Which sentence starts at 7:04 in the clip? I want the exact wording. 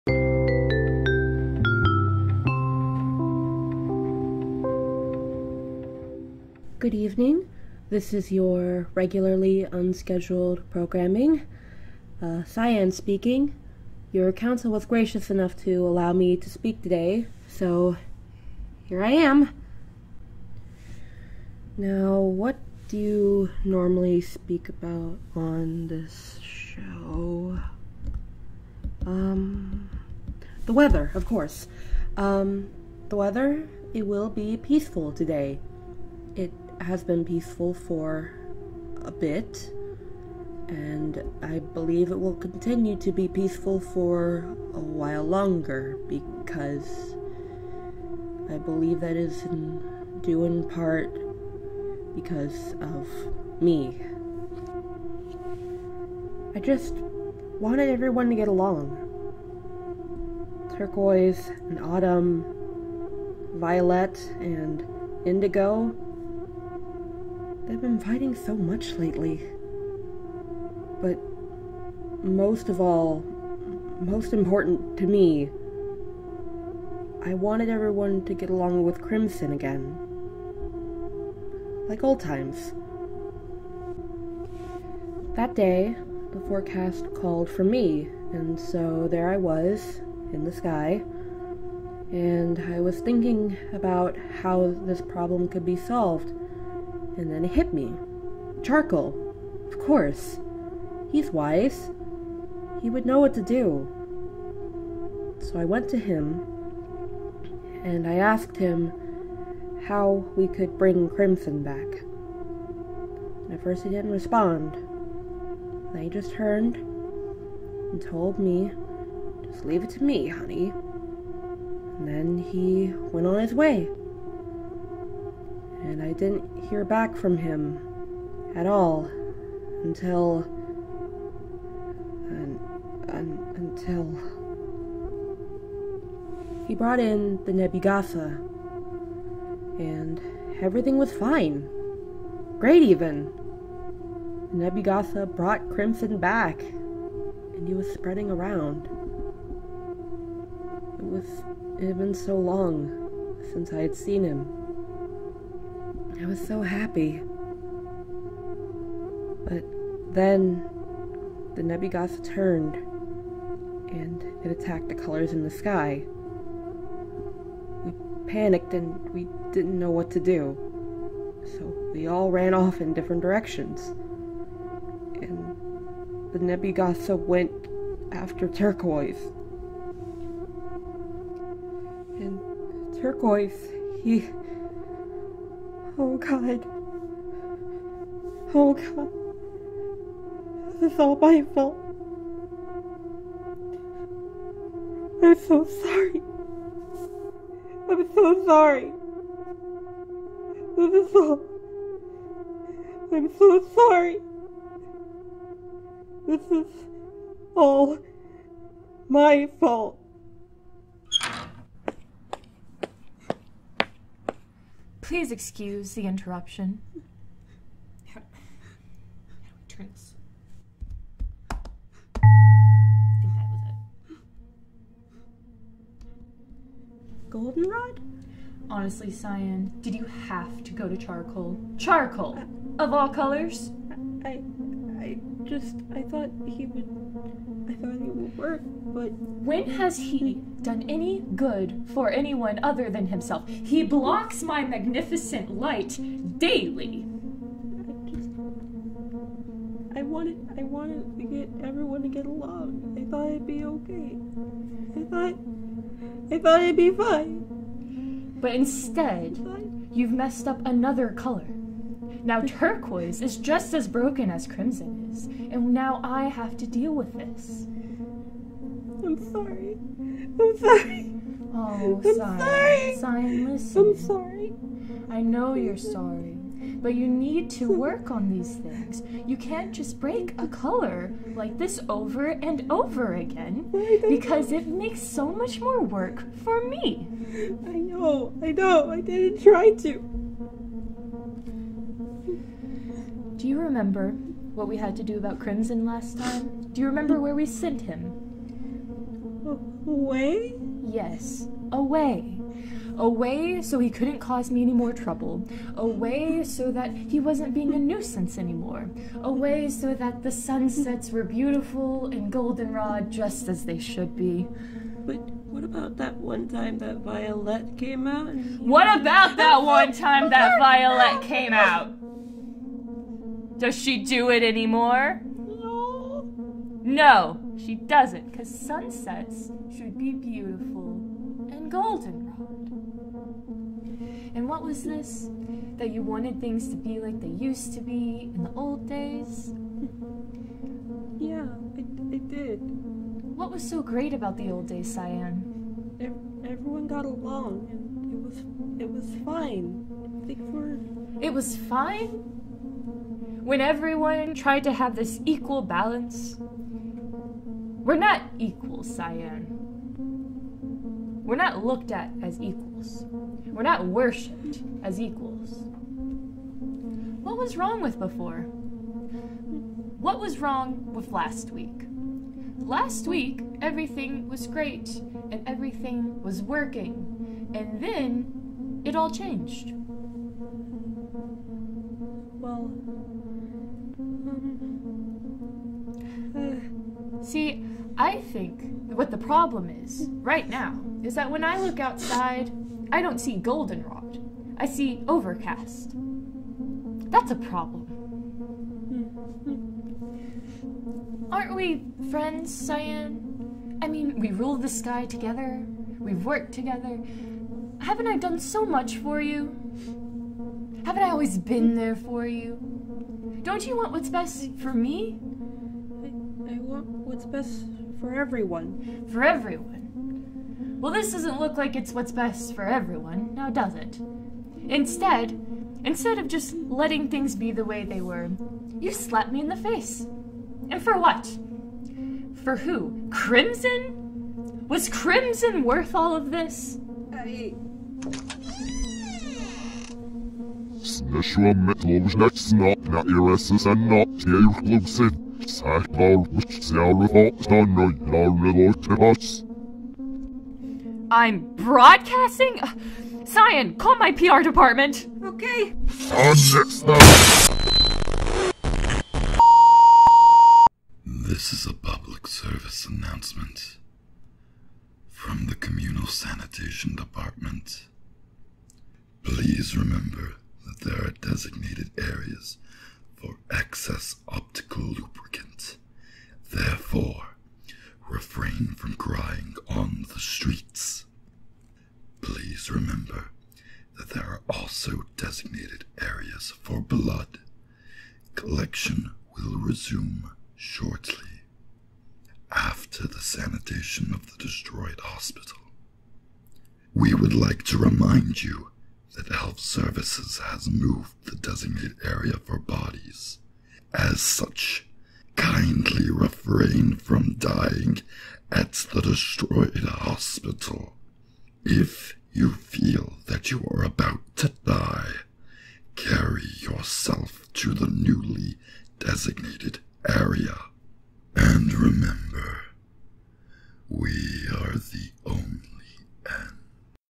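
Instead, instead of just letting things be the way they were, you slapped me in the face.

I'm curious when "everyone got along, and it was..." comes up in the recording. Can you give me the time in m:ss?
5:46.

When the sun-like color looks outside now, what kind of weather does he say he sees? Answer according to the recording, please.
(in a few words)
Overcast.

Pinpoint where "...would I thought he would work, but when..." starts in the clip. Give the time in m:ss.
3:56.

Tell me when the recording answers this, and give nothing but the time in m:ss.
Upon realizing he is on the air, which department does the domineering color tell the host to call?
7:33.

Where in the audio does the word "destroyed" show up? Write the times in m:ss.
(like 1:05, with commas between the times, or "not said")
8:14, 8:29.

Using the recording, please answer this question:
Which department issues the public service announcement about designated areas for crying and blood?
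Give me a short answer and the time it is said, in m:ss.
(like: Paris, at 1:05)
Communal Sanitation Department, at 7:45.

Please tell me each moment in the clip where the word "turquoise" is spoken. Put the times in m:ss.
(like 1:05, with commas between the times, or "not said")
1:00, 2:58, 3:03, 4:22.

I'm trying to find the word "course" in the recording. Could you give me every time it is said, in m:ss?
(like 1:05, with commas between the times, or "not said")
0:31, 1:39.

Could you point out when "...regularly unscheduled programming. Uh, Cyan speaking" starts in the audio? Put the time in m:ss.
0:08.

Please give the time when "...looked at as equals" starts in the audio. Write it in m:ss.
6:01.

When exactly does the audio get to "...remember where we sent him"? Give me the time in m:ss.
4:56.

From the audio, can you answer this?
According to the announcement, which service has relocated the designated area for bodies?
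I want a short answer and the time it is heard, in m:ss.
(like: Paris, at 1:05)
Health Services, at 8:19.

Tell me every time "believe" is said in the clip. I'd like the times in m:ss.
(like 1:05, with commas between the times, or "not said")
0:41, 0:48.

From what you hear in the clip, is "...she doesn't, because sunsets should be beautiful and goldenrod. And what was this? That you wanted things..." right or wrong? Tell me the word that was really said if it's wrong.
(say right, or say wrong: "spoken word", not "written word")
right.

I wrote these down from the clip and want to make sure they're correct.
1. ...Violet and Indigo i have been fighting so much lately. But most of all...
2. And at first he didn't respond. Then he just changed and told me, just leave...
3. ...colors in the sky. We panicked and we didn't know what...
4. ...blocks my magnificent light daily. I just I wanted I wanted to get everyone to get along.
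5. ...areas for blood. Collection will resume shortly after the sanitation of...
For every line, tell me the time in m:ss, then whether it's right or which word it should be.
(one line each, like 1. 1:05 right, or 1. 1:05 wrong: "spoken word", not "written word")
1. 1:03 right
2. 1:53 wrong: "turned", not "changed"
3. 2:44 right
4. 4:03 right
5. 8:06 right.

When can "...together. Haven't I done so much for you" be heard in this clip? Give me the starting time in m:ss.
6:46.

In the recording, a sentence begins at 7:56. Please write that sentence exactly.
Therefore, refrain from crying on the streets.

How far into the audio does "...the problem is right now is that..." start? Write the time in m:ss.
6:29.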